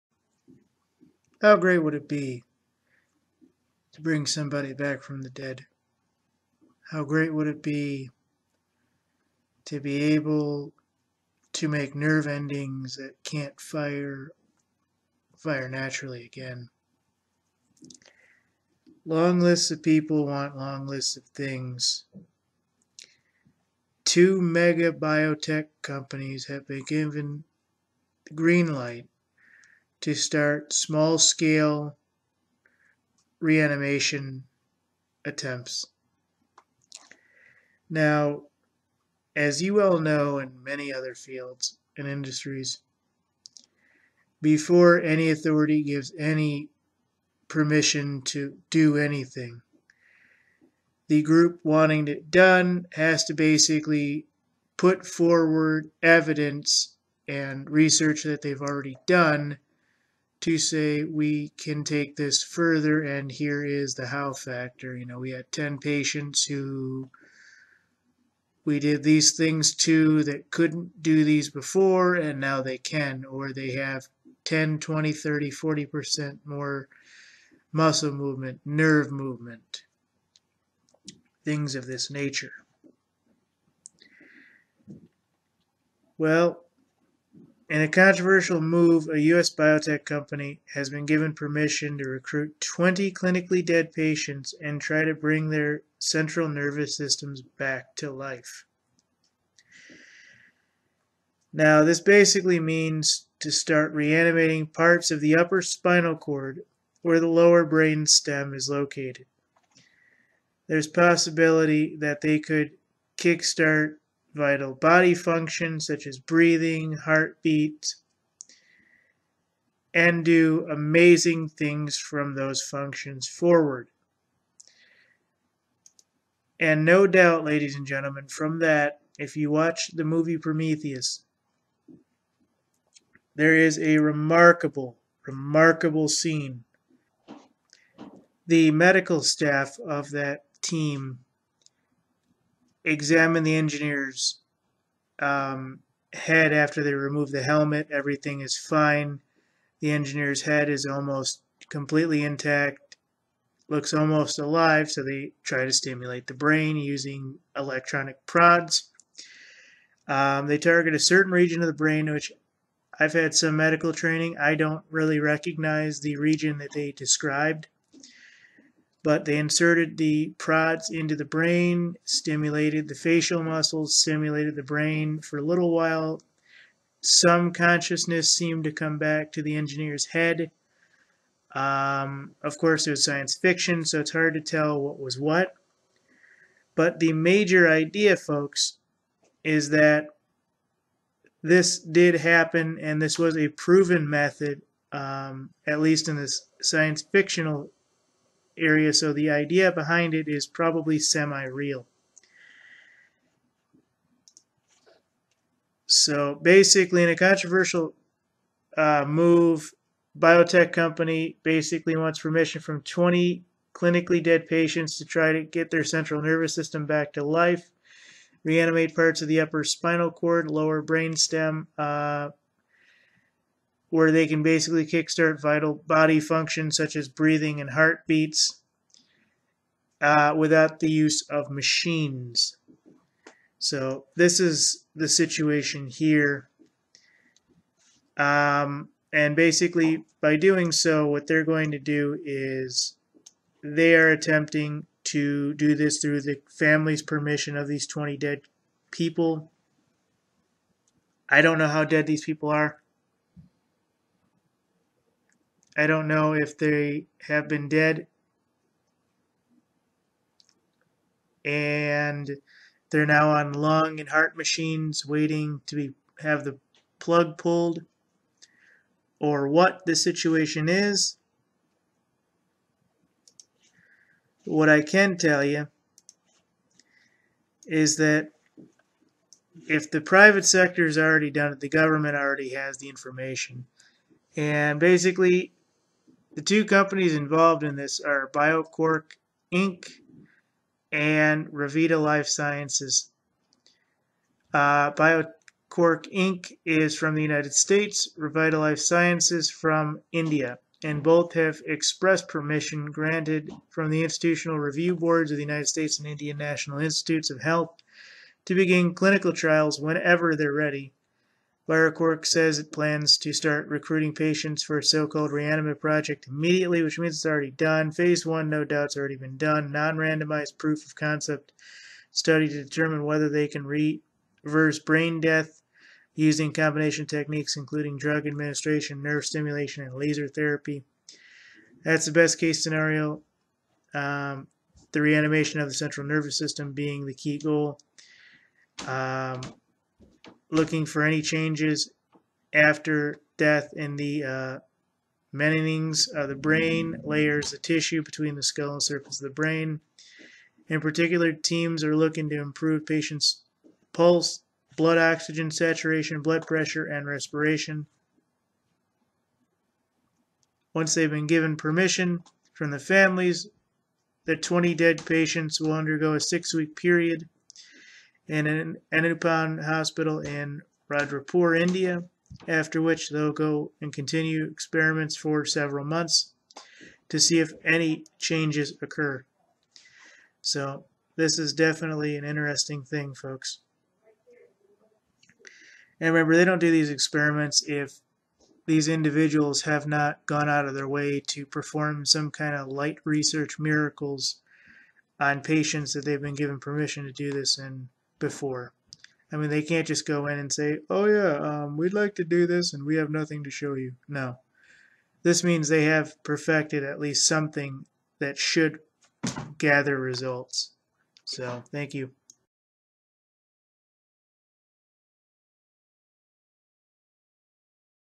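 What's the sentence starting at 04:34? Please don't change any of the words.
What I can tell you is that if the private sector has already done it, the government already has the information.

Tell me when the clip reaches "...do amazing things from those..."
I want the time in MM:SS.
02:00.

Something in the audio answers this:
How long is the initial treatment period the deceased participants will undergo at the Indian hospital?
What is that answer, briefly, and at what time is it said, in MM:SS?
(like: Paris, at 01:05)
6 weeks, at 06:06.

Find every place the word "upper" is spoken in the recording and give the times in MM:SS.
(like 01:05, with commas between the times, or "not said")
01:45, 03:39.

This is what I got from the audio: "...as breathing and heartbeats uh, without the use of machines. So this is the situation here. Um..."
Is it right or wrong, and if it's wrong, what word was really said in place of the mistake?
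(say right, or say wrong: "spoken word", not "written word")
right.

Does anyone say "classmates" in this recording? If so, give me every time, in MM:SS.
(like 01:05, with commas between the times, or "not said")
not said.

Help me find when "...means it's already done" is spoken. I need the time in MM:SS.
05:16.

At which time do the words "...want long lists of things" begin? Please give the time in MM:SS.
00:20.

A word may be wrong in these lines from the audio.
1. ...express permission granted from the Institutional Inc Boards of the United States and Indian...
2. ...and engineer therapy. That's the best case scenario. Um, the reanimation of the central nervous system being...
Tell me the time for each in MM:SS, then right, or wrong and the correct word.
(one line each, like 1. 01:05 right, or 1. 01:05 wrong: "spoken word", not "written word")
1. 05:01 wrong: "Review", not "Inc"
2. 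05:29 wrong: "laser", not "engineer".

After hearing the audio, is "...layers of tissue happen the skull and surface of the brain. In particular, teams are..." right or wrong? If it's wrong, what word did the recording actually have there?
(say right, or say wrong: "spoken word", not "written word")
wrong: "between", not "happen".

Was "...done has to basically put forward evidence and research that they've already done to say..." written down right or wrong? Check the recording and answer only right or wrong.
right.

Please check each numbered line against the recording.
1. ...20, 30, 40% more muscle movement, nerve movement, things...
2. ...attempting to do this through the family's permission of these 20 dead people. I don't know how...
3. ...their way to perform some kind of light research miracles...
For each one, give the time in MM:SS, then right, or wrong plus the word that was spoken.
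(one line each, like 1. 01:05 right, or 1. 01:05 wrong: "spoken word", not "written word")
1. 01:14 right
2. 04:04 right
3. 06:30 right.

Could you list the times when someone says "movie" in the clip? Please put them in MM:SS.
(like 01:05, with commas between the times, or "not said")
02:10.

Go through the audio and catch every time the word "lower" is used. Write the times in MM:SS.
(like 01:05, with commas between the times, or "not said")
01:47, 03:40.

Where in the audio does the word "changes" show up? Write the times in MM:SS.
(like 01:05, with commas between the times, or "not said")
05:41, 06:18.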